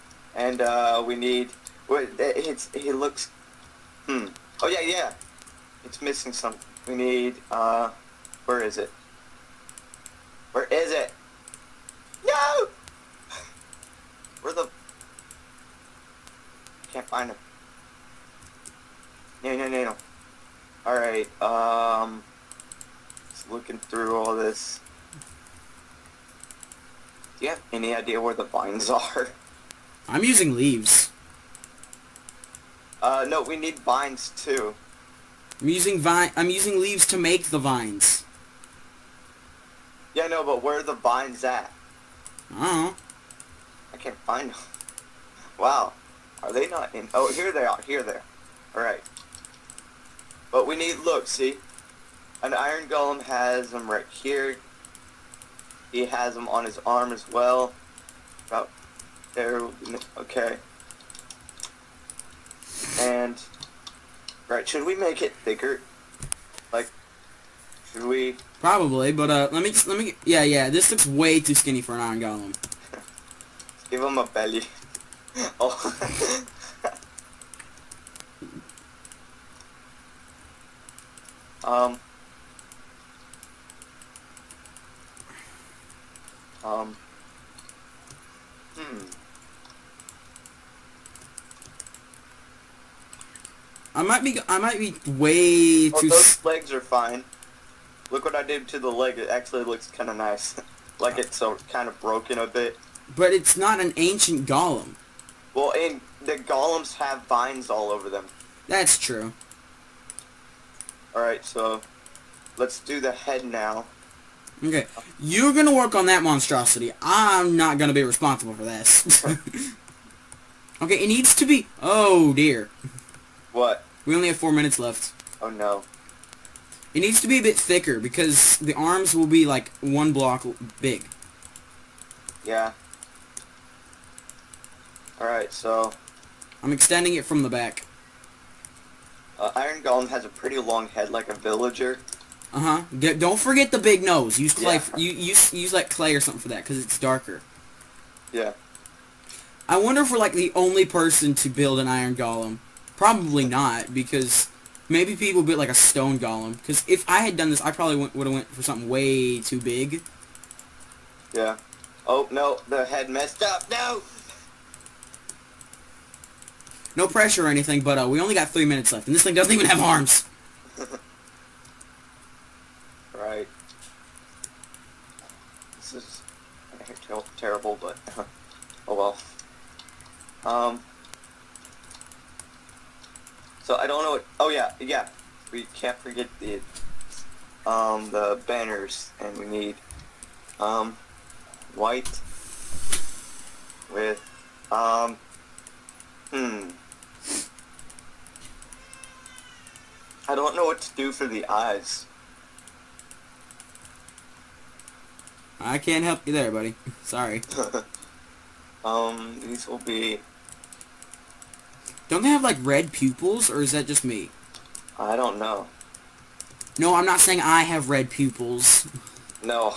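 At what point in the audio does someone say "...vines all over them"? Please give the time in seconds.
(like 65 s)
107 s.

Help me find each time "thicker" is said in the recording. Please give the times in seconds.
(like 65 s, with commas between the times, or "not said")
65 s, 127 s.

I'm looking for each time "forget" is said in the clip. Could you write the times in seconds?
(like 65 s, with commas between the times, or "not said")
143 s, 185 s.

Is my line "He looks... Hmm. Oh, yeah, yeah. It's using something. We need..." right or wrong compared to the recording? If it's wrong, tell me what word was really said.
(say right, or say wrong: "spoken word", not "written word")
wrong: "missing", not "using".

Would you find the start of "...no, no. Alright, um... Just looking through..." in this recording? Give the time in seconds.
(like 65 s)
19 s.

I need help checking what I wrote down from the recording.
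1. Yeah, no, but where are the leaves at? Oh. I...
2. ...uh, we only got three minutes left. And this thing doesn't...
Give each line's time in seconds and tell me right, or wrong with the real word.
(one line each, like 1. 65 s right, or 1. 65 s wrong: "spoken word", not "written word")
1. 40 s wrong: "vines", not "leaves"
2. 168 s right.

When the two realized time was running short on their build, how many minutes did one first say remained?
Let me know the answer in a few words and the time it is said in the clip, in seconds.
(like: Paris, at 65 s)
4, at 124 s.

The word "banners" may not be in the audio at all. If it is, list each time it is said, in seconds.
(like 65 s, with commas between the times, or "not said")
188 s.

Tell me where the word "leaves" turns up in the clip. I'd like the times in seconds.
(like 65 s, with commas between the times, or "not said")
30 s, 36 s.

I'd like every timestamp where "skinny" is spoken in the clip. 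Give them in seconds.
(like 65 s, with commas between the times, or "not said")
71 s.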